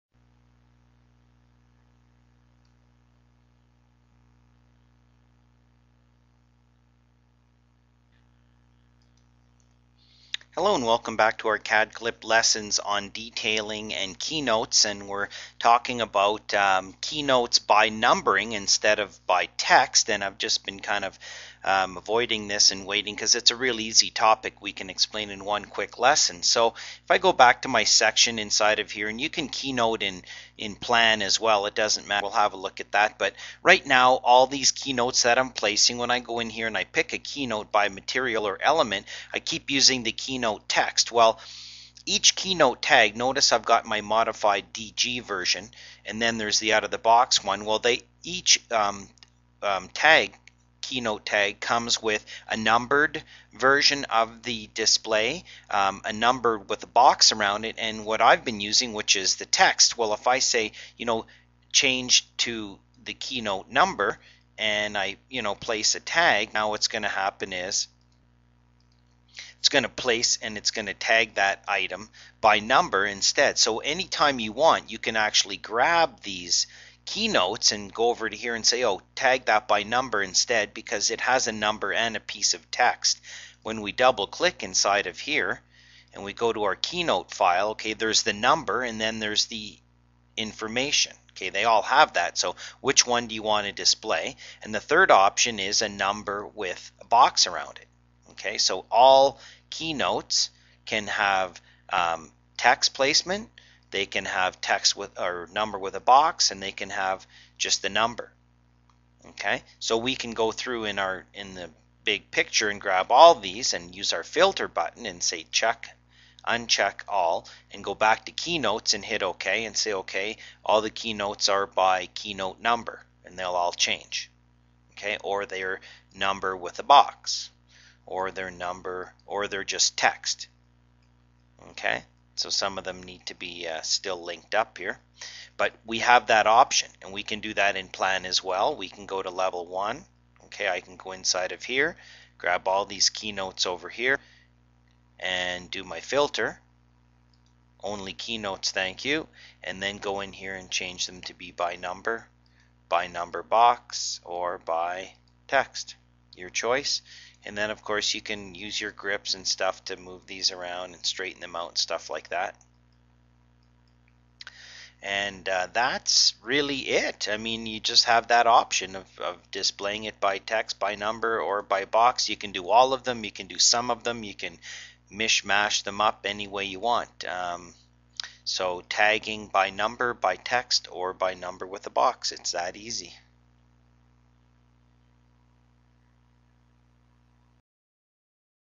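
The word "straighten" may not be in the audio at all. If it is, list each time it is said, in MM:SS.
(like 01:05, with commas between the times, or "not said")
02:41.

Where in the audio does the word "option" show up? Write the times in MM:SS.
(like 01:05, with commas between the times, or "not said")
01:35, 02:16, 02:48.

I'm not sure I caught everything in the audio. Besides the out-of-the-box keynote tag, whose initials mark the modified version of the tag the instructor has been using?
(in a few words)
DG.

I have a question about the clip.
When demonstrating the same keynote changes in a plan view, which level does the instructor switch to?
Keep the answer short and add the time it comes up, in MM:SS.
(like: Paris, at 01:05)
level one, at 02:19.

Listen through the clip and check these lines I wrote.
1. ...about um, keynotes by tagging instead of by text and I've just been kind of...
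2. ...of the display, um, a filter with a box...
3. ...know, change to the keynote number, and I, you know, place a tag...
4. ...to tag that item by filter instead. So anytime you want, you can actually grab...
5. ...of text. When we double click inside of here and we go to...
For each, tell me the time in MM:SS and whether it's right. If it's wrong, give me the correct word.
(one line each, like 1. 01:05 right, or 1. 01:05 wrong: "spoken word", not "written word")
1. 00:16 wrong: "numbering", not "tagging"
2. 00:54 wrong: "number", not "filter"
3. 01:01 right
4. 01:10 wrong: "number", not "filter"
5. 01:22 right.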